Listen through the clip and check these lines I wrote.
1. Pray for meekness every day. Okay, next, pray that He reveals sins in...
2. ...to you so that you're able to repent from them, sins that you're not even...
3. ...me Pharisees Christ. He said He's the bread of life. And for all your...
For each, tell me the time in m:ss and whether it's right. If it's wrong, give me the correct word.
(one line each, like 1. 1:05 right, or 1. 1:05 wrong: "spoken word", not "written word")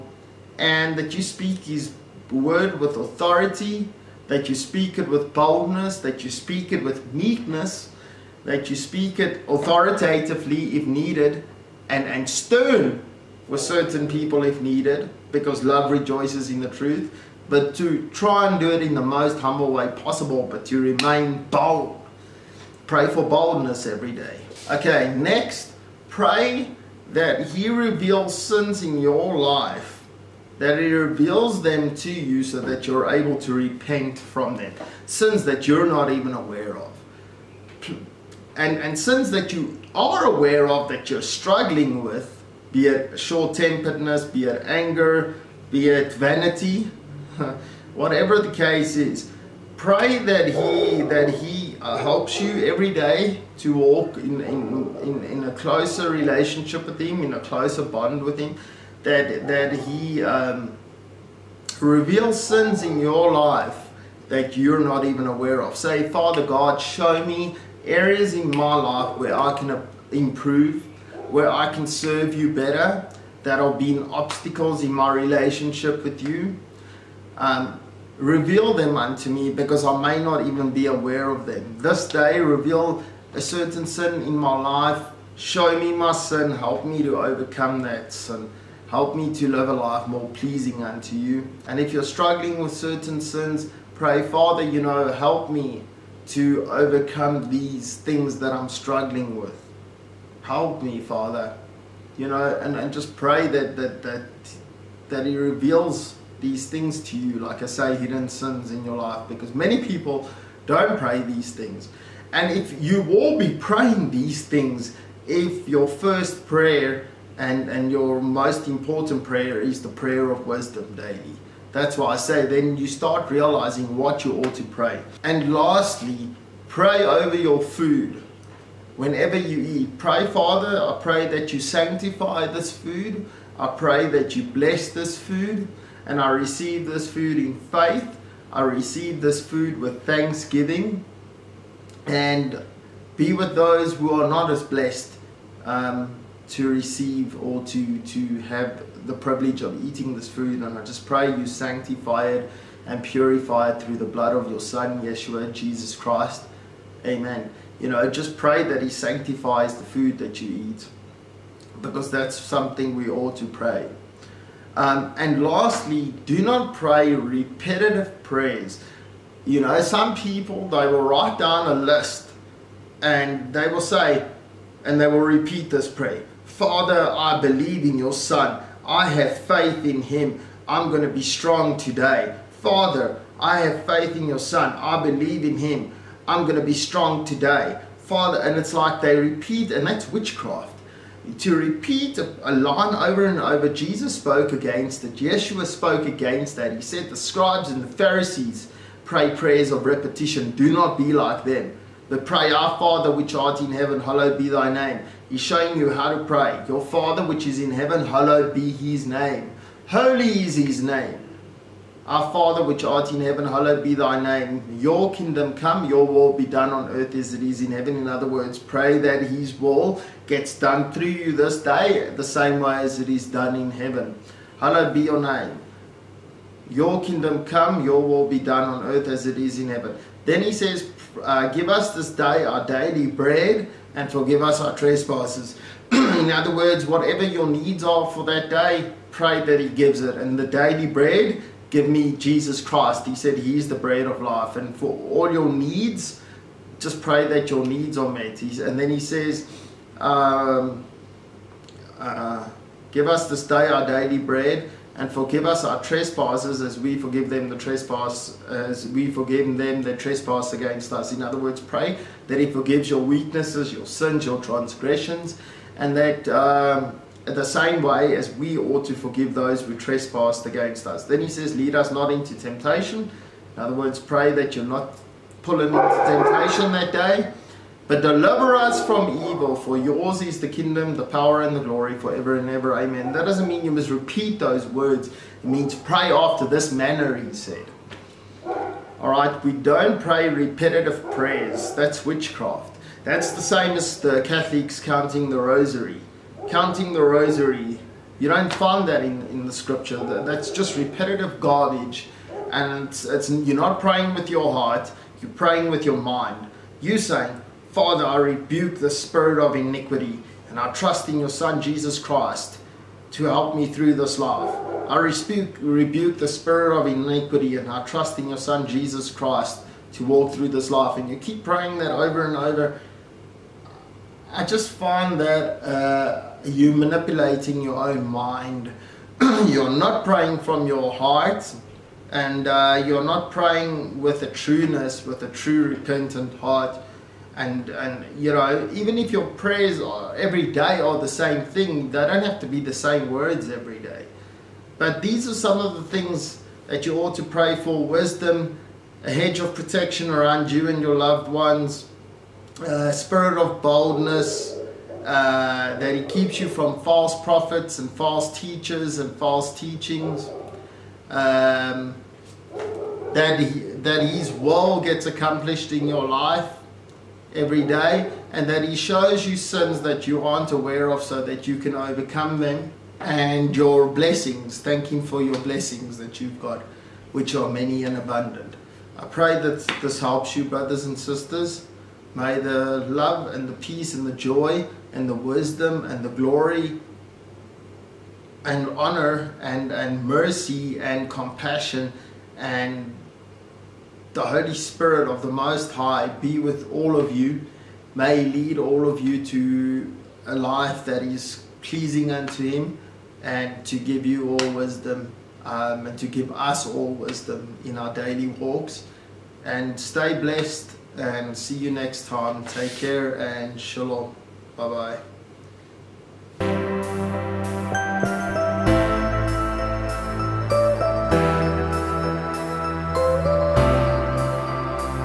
1. 0:22 wrong: "boldness", not "meekness"
2. 0:31 right
3. 4:01 wrong: "Jesus", not "Pharisees".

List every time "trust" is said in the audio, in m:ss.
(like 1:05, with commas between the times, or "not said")
5:10, 5:17.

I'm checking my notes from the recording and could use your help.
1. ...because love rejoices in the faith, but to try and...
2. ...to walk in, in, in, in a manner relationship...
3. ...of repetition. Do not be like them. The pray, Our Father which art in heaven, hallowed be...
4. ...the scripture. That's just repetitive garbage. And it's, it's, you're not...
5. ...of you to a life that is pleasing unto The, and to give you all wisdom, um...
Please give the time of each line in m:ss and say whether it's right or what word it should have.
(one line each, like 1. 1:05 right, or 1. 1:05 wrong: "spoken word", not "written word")
1. 0:15 wrong: "truth", not "faith"
2. 0:53 wrong: "closer", not "manner"
3. 3:19 right
4. 4:59 right
5. 6:38 wrong: "Him", not "The".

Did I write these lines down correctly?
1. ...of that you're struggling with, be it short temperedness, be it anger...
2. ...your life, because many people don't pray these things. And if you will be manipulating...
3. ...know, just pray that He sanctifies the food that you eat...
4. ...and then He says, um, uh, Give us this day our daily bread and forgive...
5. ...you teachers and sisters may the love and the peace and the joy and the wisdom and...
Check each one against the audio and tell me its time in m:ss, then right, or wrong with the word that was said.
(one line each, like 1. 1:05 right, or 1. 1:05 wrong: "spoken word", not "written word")
1. 0:40 right
2. 1:48 wrong: "praying", not "manipulating"
3. 2:37 right
4. 4:08 right
5. 6:20 wrong: "brothers", not "teachers".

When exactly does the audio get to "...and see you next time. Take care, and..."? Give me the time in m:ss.
6:50.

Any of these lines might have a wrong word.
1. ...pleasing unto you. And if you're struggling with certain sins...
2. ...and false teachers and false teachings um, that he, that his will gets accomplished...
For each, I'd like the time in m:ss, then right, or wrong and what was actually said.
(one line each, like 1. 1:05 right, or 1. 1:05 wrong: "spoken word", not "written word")
1. 1:30 right
2. 5:57 right.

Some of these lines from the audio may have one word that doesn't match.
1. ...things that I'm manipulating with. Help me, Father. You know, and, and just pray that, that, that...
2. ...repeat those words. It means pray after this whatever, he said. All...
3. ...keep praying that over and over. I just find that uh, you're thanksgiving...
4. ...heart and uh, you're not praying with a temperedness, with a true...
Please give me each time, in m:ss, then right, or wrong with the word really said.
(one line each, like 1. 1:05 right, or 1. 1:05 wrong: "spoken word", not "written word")
1. 1:37 wrong: "struggling", not "manipulating"
2. 4:43 wrong: "manner", not "whatever"
3. 5:21 wrong: "manipulating", not "thanksgiving"
4. 5:30 wrong: "trueness", not "temperedness".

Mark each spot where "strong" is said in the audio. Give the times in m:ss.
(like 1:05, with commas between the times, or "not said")
3:01, 3:06.